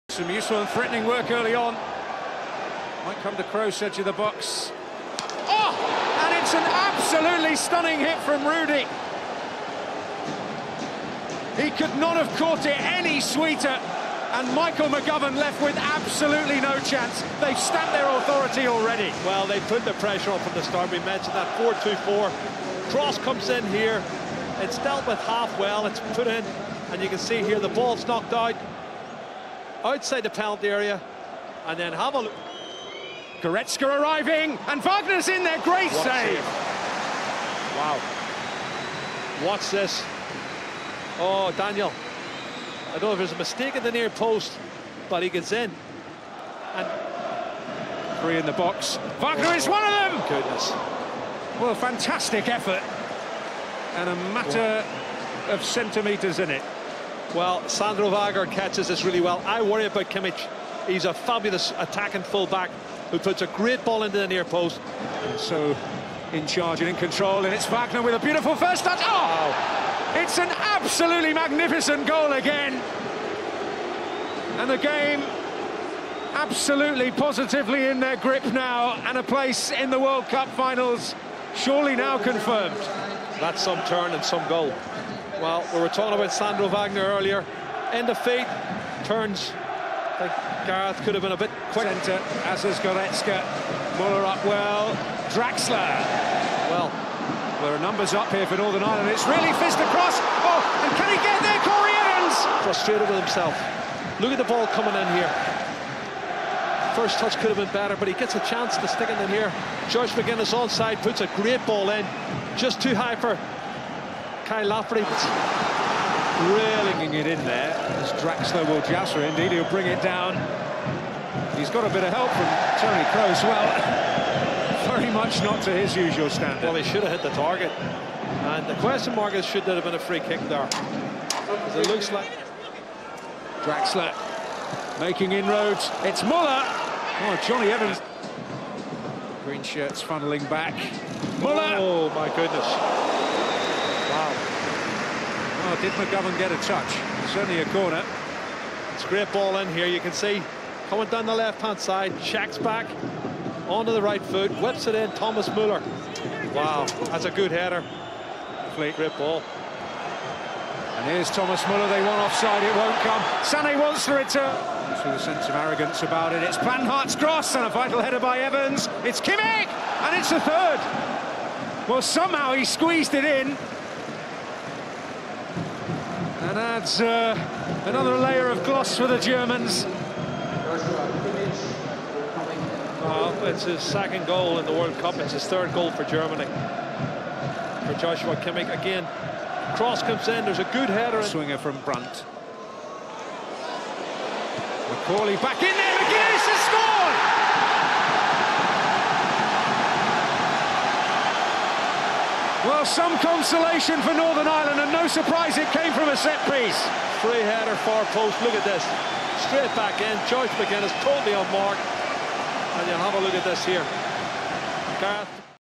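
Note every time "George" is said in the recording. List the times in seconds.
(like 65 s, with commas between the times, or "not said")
109 s, 210 s.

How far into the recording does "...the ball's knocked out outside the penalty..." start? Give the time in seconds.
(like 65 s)
27 s.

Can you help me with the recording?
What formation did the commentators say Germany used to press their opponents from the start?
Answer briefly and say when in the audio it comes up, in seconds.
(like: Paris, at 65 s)
4-2-4, at 21 s.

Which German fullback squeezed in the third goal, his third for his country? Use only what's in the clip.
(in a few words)
Joshua Kimmich.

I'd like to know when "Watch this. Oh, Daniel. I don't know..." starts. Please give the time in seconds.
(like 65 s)
39 s.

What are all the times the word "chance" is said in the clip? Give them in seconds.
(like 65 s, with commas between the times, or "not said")
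16 s, 108 s.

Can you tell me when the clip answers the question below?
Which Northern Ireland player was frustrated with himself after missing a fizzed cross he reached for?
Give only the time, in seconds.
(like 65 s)
101 s.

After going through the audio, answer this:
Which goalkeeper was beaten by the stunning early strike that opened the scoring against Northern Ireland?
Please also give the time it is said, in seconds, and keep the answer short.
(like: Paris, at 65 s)
Michael McGovern, at 14 s.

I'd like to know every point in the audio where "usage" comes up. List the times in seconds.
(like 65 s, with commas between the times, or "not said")
not said.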